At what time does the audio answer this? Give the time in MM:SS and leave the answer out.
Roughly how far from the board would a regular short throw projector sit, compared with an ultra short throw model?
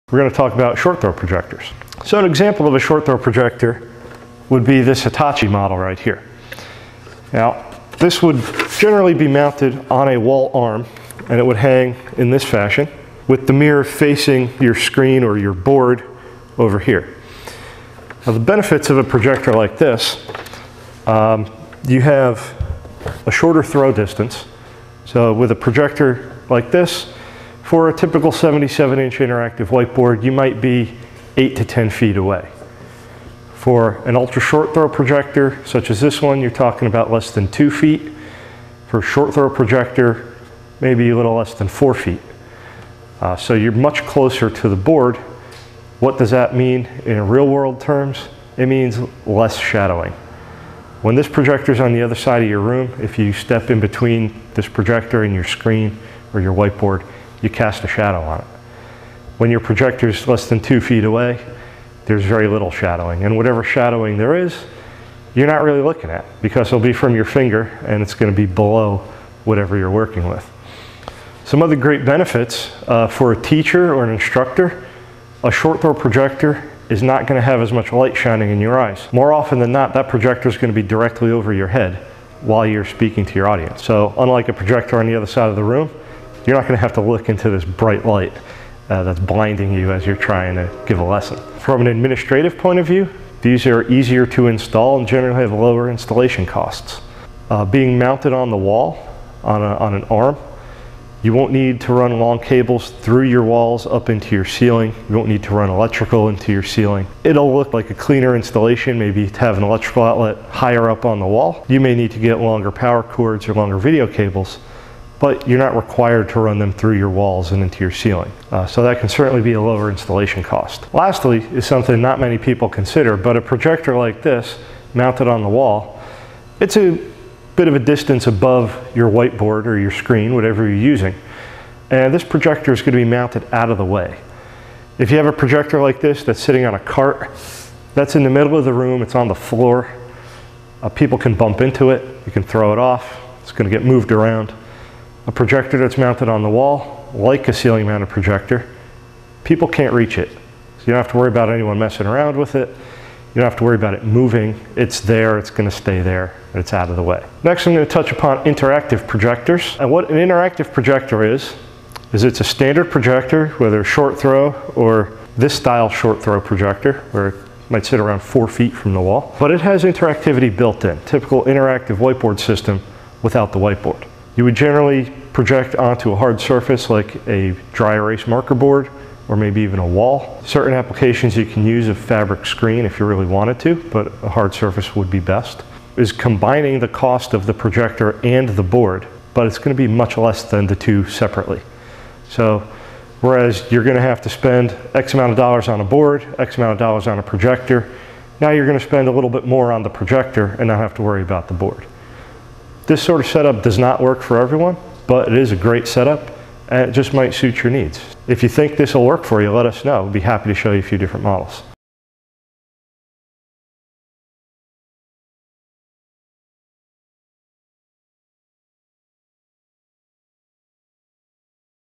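00:41.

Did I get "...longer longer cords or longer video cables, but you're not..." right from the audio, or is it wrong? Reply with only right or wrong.
wrong.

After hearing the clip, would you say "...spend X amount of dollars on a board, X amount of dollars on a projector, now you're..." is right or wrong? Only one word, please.
right.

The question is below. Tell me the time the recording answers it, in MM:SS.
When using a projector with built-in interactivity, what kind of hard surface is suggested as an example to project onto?
02:57.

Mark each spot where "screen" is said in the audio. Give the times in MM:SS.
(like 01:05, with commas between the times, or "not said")
00:14, 00:55, 02:09, 03:02.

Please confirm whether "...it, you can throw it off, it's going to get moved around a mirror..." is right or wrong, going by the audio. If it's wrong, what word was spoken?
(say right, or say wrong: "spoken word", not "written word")
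wrong: "projector", not "mirror".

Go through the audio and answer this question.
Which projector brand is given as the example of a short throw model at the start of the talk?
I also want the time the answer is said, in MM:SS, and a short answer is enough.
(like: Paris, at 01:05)
Hitachi, at 00:05.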